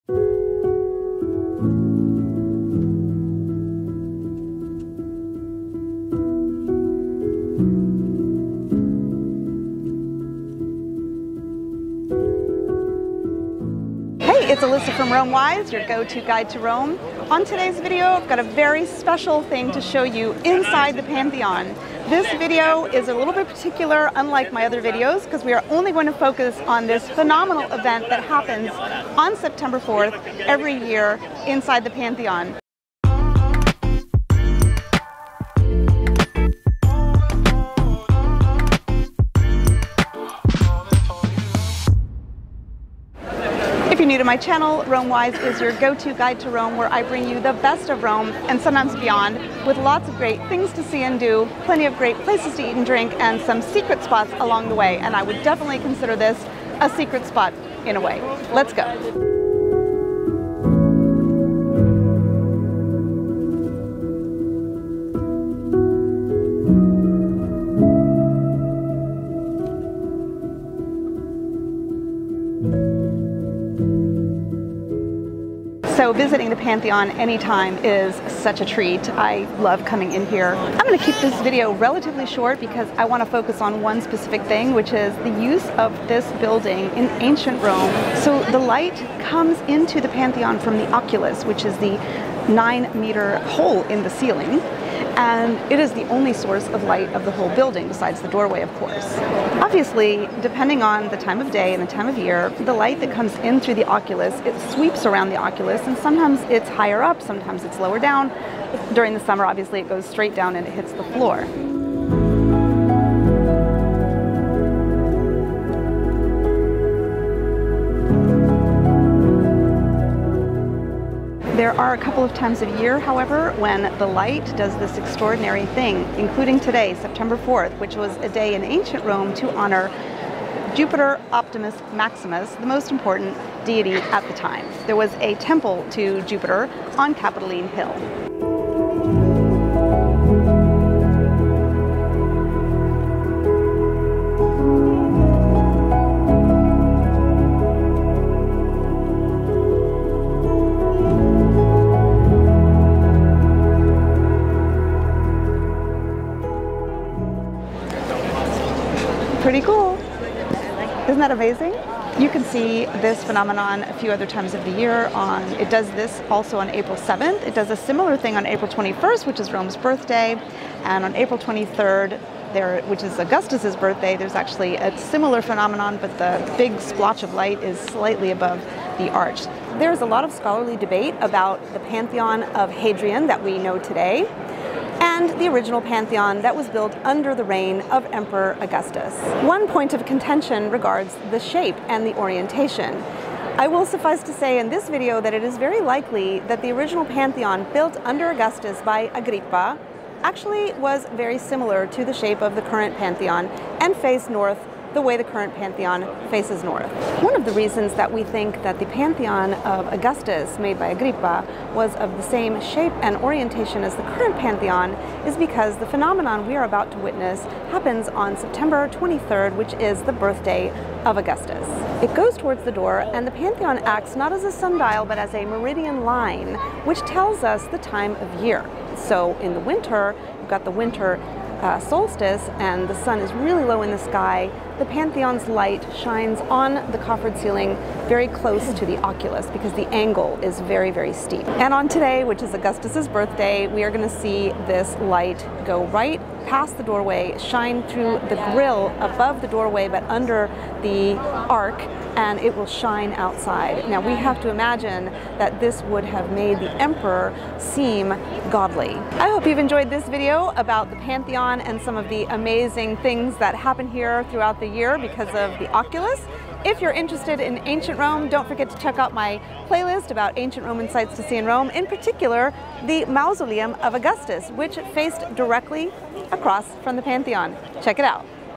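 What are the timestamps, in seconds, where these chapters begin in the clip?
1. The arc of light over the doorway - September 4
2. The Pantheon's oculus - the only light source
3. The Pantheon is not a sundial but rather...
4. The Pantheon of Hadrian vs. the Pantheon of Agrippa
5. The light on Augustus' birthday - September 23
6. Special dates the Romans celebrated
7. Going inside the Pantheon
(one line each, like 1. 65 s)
1. 148 s
2. 81 s
3. 214 s
4. 180 s
5. 245 s
6. 122 s
7. 60 s.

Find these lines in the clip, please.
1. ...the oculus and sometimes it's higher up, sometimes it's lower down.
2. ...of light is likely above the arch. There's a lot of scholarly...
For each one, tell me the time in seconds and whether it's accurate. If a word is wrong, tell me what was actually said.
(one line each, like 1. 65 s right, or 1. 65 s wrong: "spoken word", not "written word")
1. 105 s right
2. 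177 s wrong: "slightly", not "likely".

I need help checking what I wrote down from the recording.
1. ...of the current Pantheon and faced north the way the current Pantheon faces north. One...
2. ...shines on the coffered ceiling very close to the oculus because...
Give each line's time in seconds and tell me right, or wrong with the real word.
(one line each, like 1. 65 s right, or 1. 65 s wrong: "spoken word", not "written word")
1. 202 s right
2. 235 s right.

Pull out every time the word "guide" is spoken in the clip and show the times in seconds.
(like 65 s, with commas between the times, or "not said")
16 s, 46 s.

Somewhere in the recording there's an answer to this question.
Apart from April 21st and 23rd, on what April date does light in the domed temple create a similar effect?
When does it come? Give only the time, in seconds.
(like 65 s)
166 s.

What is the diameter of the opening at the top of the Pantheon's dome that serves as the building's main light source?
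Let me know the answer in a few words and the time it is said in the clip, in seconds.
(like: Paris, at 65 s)
9 meters, at 92 s.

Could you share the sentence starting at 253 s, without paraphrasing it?
Now we have to imagine that this would have made the emperor seem godly.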